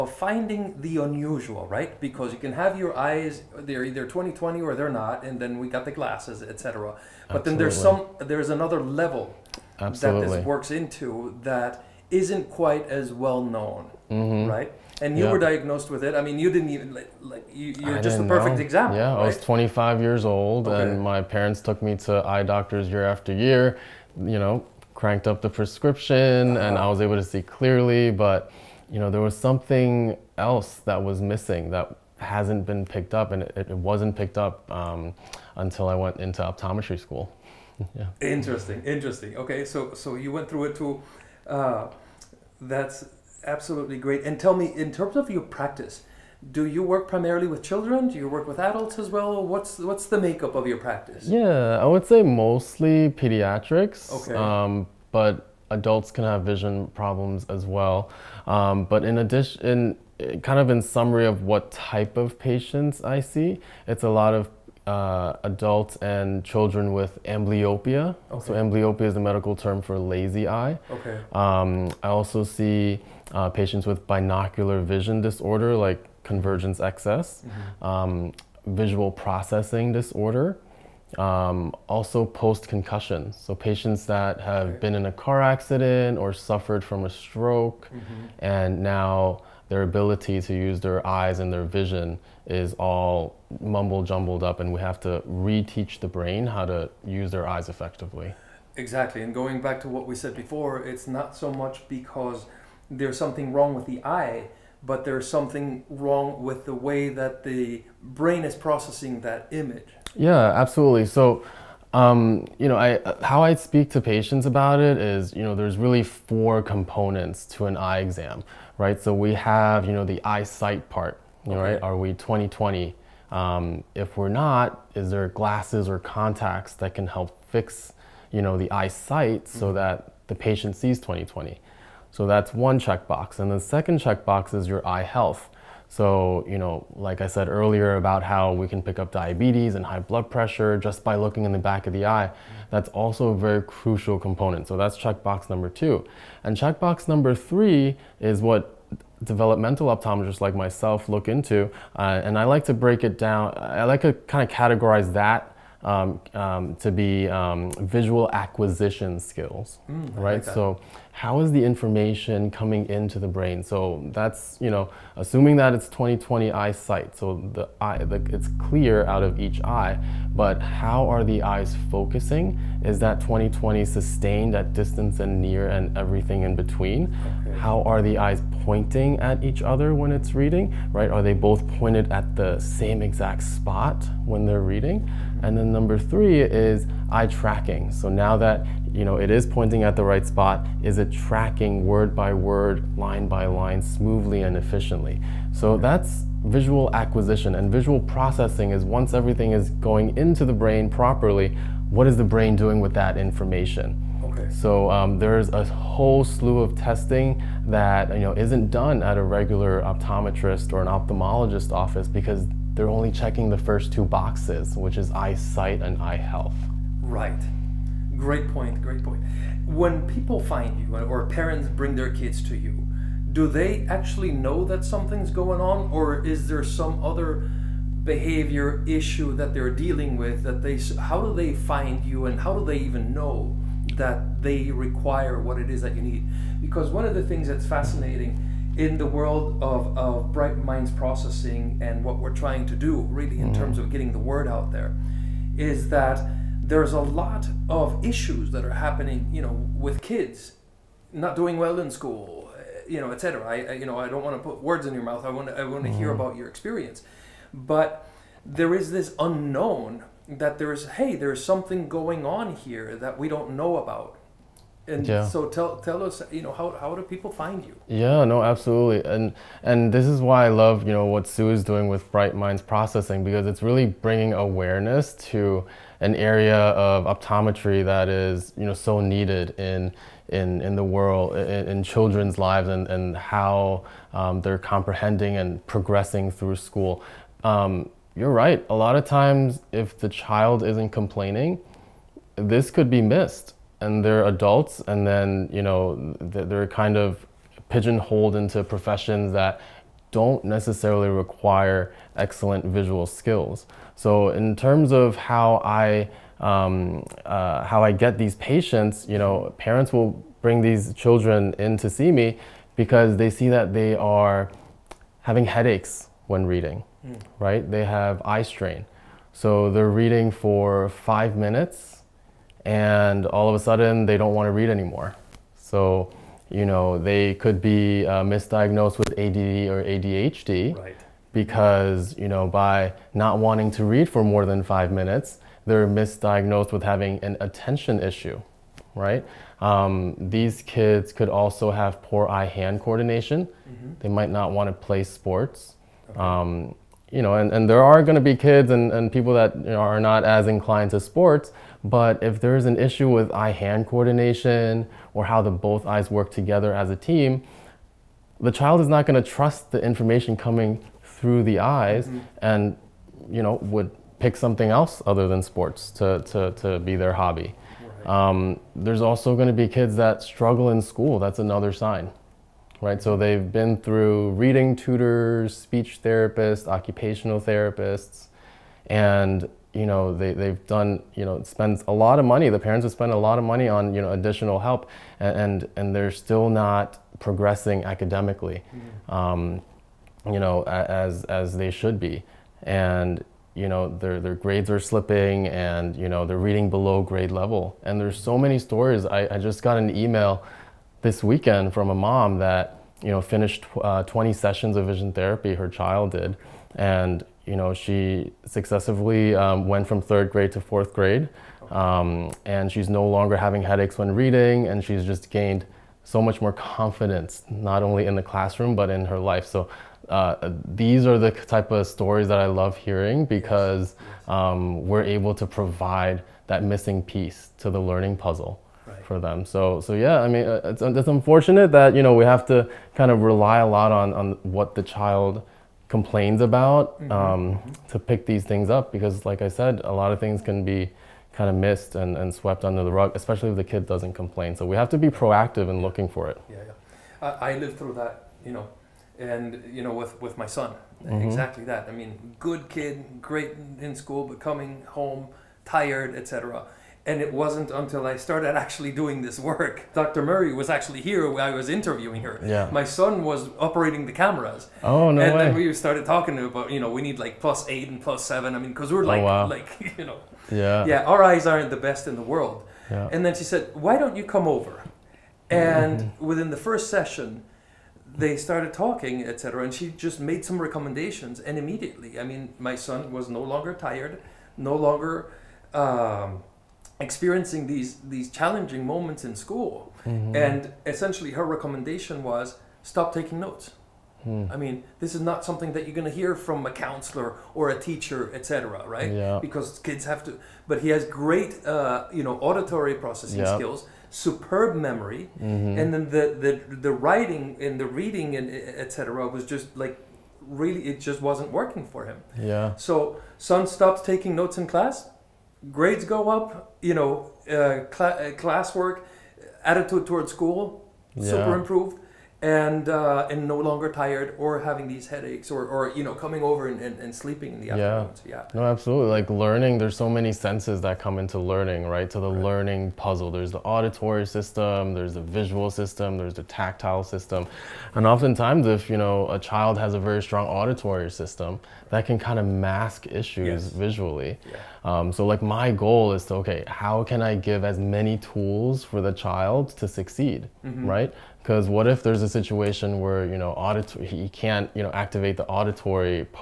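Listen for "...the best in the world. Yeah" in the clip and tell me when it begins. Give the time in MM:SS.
07:51.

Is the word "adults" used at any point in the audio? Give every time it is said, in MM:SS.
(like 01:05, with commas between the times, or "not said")
00:48, 00:55, 01:05, 04:54.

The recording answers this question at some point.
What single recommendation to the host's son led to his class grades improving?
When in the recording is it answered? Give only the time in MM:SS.
08:12.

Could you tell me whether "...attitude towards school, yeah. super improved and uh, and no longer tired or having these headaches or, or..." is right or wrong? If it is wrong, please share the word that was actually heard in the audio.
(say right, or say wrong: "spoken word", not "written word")
right.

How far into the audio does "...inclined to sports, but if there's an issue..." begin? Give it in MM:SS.
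05:50.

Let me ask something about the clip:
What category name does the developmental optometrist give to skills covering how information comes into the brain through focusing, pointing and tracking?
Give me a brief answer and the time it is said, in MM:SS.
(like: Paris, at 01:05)
visual acquisition skills, at 02:37.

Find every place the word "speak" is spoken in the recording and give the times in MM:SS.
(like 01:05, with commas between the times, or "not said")
01:53.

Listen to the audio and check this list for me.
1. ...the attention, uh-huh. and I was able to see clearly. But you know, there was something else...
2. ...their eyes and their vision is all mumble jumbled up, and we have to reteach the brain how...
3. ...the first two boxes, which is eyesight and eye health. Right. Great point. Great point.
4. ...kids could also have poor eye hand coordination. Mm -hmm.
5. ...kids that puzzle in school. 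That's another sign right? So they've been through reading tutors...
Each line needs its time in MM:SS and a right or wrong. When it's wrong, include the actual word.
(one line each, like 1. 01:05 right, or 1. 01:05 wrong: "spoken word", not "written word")
1. 00:25 wrong: "prescription", not "attention"
2. 01:30 right
3. 03:33 right
4. 05:40 right
5. 06:09 wrong: "struggle", not "puzzle".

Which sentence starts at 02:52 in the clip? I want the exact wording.
Is that 20/20 sustained at distance and near and everything in between?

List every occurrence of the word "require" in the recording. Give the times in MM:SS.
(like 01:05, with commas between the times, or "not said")
03:54, 05:01.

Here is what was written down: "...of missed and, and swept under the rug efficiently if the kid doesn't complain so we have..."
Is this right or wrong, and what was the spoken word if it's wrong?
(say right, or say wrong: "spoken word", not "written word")
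wrong: "especially", not "efficiently".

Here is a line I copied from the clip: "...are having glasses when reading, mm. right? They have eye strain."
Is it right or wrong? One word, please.
wrong.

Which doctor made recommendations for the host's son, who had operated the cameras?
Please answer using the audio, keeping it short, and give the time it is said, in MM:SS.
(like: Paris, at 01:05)
Dr. Murray, at 07:39.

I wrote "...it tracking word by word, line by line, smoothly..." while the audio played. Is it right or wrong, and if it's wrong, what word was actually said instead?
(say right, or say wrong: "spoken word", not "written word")
right.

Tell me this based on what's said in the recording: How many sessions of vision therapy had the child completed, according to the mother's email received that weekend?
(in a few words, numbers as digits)
20.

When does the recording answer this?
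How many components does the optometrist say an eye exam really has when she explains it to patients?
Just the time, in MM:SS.
01:56.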